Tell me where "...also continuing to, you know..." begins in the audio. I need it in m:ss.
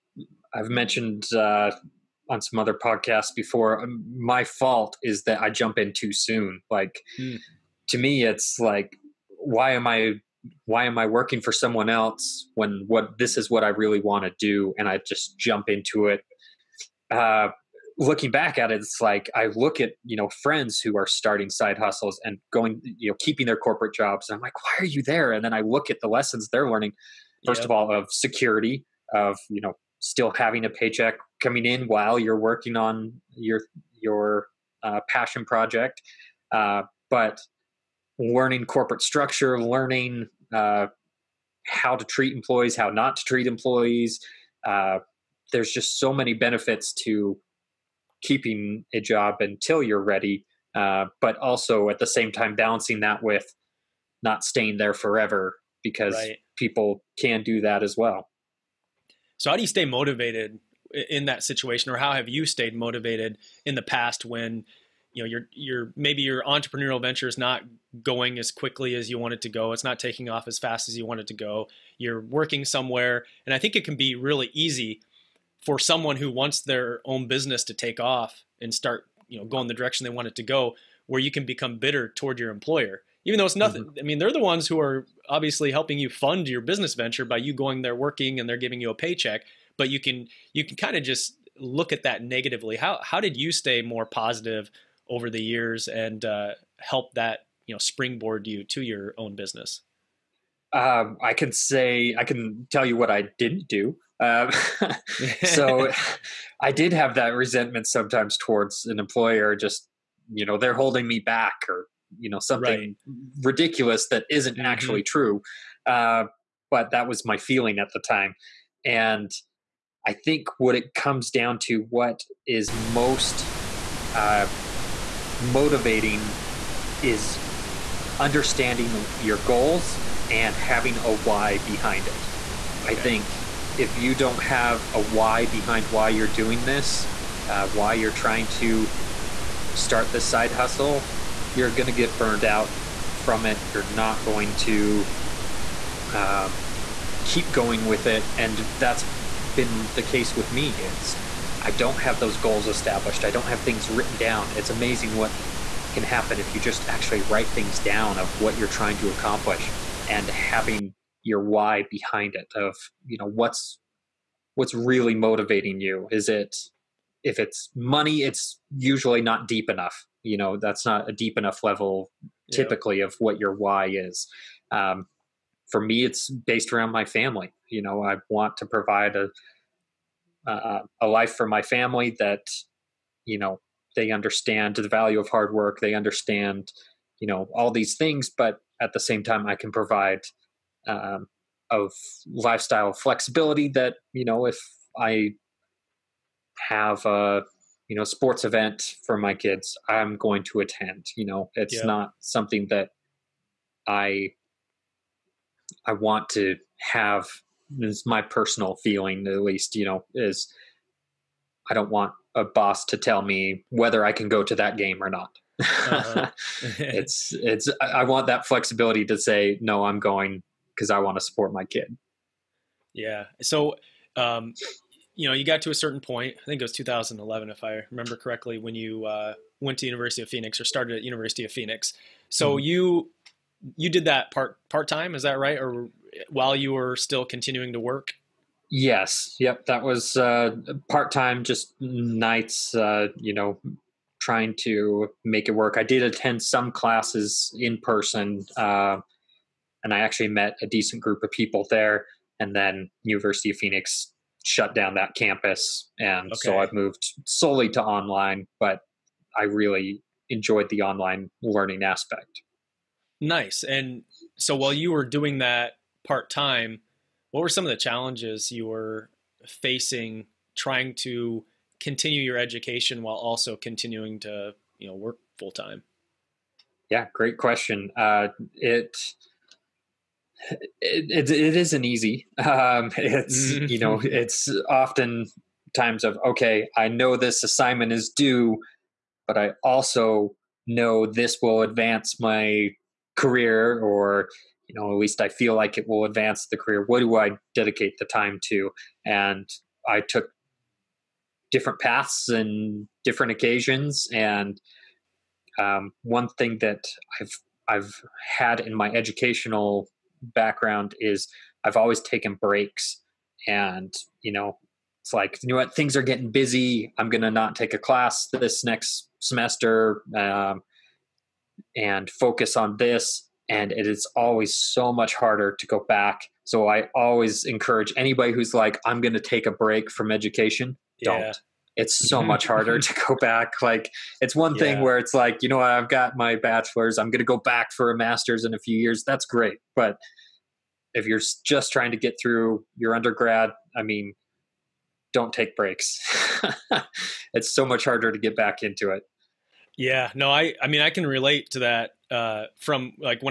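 4:33.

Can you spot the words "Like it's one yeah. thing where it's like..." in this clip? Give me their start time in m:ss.
5:33.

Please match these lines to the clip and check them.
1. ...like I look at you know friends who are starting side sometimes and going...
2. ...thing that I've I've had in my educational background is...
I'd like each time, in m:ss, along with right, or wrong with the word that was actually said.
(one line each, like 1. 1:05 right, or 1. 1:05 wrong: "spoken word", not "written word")
1. 0:19 wrong: "hustles", not "sometimes"
2. 5:06 right.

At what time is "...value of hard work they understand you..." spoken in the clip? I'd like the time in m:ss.
3:04.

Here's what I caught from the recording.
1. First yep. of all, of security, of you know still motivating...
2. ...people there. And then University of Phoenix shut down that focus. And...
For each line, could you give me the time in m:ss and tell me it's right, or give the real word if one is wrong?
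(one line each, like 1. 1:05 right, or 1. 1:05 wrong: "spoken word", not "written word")
1. 0:27 wrong: "having", not "motivating"
2. 4:11 wrong: "campus", not "focus".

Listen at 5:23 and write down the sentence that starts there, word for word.
And it is always so much harder to go back.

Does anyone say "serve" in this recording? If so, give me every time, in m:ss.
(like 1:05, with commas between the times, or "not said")
not said.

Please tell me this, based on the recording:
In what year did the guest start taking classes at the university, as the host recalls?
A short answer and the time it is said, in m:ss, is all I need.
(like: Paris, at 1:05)
2011, at 3:46.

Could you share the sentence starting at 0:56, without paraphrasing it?
people can do that as well.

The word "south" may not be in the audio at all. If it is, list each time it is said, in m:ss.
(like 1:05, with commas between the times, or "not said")
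not said.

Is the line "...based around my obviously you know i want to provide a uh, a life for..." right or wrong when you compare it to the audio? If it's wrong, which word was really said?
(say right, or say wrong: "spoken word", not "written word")
wrong: "family", not "obviously".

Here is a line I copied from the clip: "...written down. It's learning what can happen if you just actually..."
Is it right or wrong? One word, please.
wrong.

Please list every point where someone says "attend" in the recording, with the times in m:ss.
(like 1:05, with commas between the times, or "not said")
3:20, 4:06.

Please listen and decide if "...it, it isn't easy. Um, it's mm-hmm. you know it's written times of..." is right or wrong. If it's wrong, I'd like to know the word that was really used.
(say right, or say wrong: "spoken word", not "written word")
wrong: "often", not "written".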